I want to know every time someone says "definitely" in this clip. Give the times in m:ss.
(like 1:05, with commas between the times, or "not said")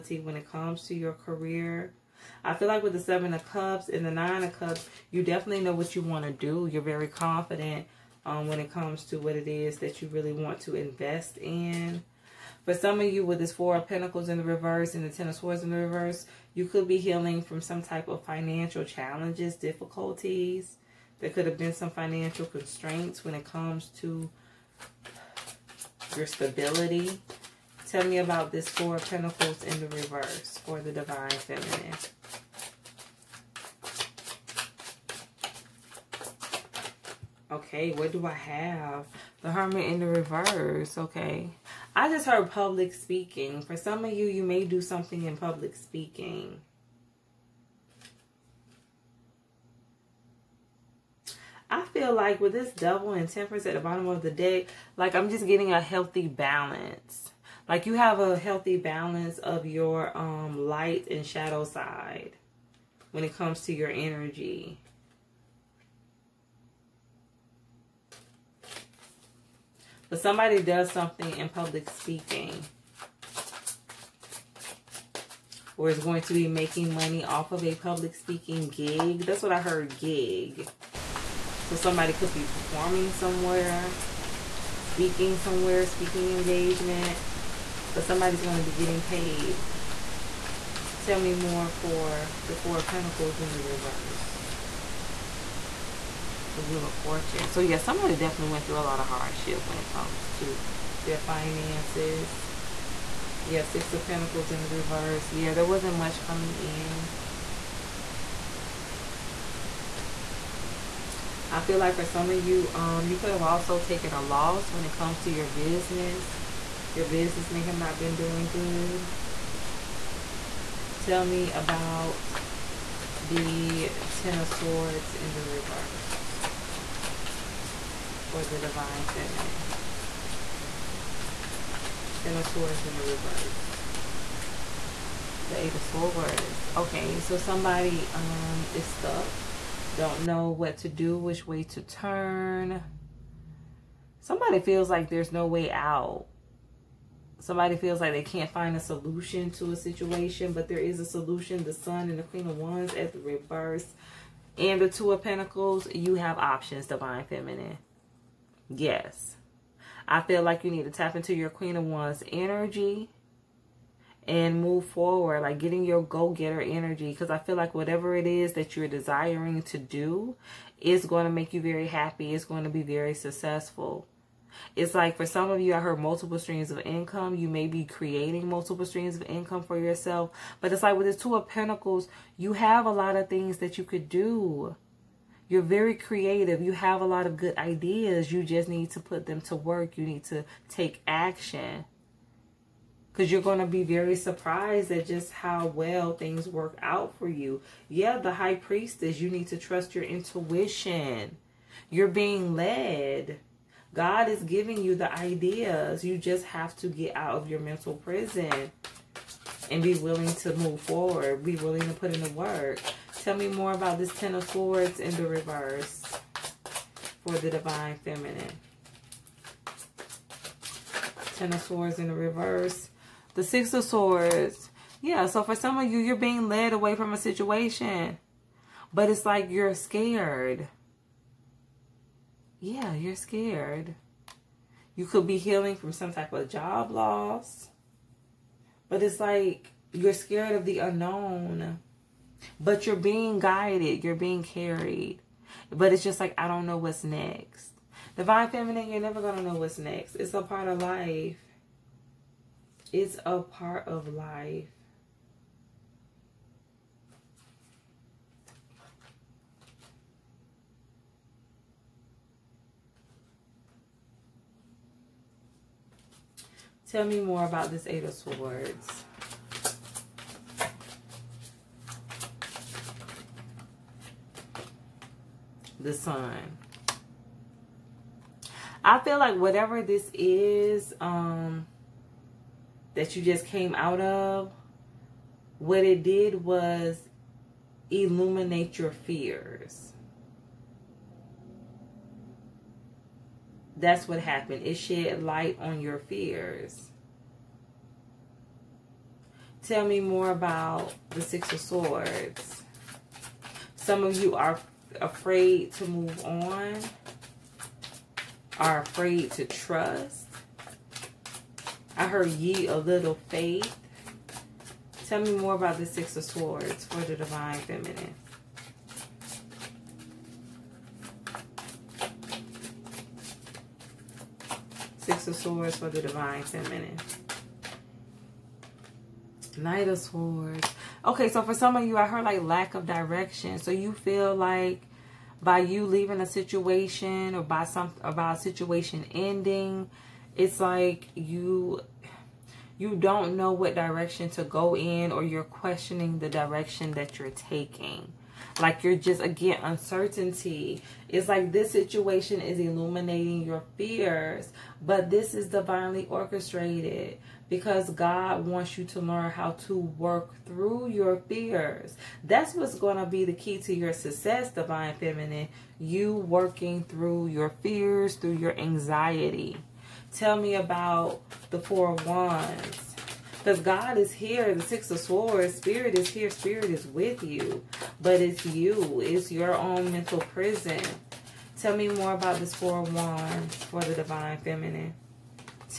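0:05, 1:38.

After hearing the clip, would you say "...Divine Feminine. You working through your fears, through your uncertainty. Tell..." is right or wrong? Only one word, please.
wrong.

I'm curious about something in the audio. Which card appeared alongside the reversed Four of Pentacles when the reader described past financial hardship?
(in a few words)
Wheel of Fortune.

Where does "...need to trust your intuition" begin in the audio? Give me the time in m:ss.
3:19.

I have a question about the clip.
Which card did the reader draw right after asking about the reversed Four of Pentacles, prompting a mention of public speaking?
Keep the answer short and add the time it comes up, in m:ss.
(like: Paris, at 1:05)
The Hermit, at 0:39.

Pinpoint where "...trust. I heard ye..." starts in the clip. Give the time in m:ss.
5:09.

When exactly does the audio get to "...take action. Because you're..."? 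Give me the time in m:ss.
3:10.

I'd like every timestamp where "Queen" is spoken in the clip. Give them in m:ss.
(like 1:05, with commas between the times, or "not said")
2:32, 2:41.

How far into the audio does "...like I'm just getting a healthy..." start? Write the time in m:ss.
0:54.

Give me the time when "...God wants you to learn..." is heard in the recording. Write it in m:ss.
5:57.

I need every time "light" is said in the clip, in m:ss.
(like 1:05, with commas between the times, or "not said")
1:00, 4:55.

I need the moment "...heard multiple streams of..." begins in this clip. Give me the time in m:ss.
2:55.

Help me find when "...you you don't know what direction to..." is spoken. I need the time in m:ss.
5:41.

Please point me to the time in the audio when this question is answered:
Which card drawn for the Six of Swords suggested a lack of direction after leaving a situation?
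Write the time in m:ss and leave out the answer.
5:29.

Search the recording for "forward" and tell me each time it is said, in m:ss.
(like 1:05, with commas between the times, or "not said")
2:44, 3:30.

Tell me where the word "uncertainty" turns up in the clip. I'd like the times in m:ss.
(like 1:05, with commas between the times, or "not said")
5:49.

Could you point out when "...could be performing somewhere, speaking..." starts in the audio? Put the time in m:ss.
1:22.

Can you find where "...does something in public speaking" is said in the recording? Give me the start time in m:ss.
1:10.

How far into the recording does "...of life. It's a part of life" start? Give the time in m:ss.
4:10.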